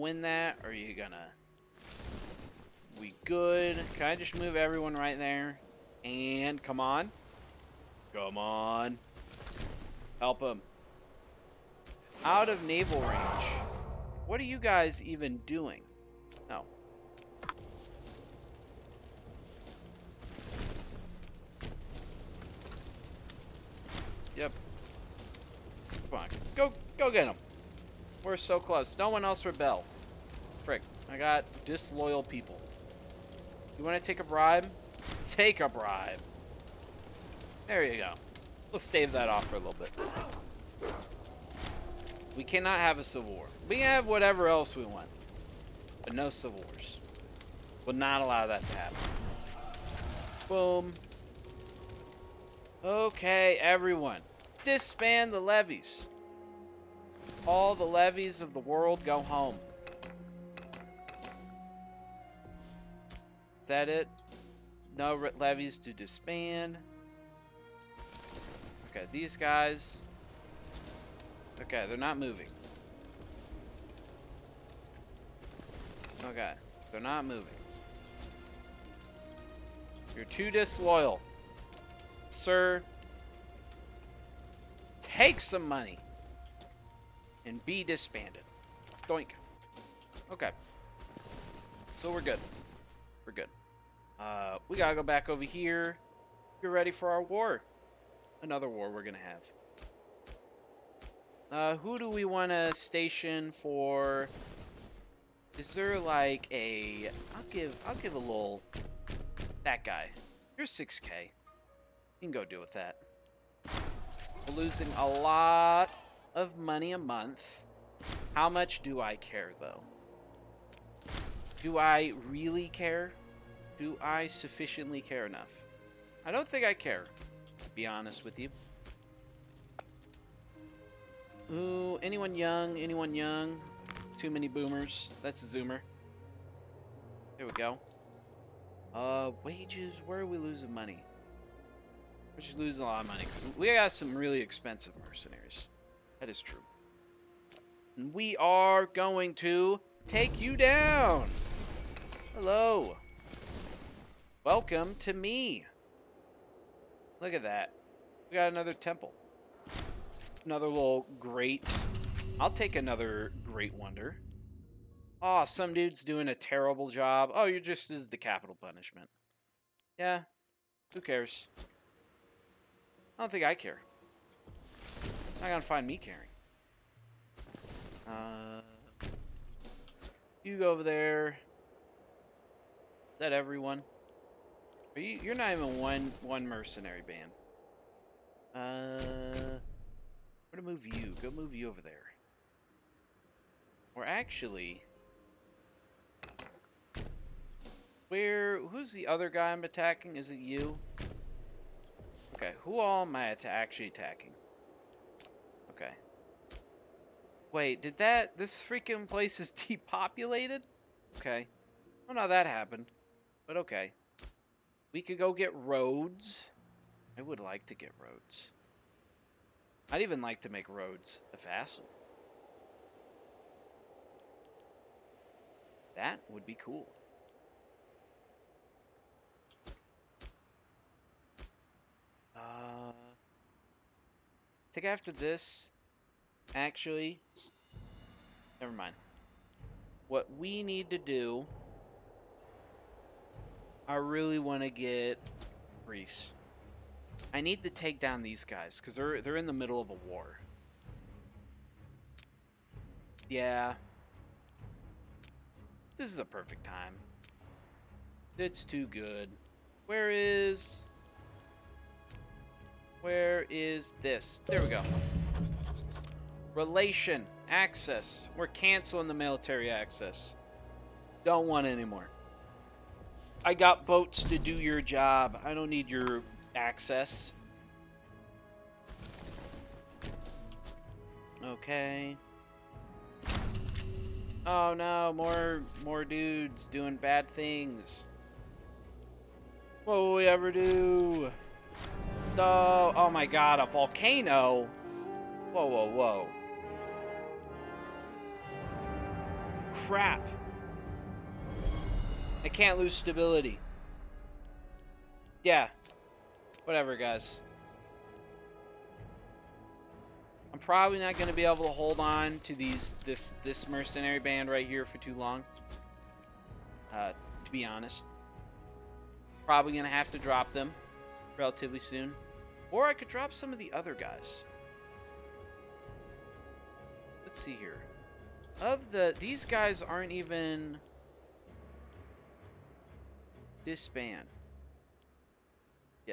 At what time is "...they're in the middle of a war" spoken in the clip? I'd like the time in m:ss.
4:09.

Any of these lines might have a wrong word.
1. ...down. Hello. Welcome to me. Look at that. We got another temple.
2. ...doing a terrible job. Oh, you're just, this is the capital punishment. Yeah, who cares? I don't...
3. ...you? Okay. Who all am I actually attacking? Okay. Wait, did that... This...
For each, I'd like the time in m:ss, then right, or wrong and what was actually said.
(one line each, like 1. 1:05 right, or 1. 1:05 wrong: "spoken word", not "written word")
1. 2:30 right
2. 2:46 right
3. 3:20 right.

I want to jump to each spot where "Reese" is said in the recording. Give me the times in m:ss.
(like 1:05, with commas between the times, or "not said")
4:05.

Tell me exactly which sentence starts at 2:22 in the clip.
We're just losing a lot of money.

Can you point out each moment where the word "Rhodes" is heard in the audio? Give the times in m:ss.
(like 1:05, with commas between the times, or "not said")
3:35, 3:40.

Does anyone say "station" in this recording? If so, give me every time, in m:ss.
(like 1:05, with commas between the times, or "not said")
1:42.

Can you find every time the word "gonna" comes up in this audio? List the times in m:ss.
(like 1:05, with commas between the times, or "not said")
0:00, 1:39, 2:55, 3:10.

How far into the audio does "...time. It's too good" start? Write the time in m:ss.
4:16.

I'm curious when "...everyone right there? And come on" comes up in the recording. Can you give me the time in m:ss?
0:04.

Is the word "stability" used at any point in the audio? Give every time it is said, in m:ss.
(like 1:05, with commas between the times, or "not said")
5:02.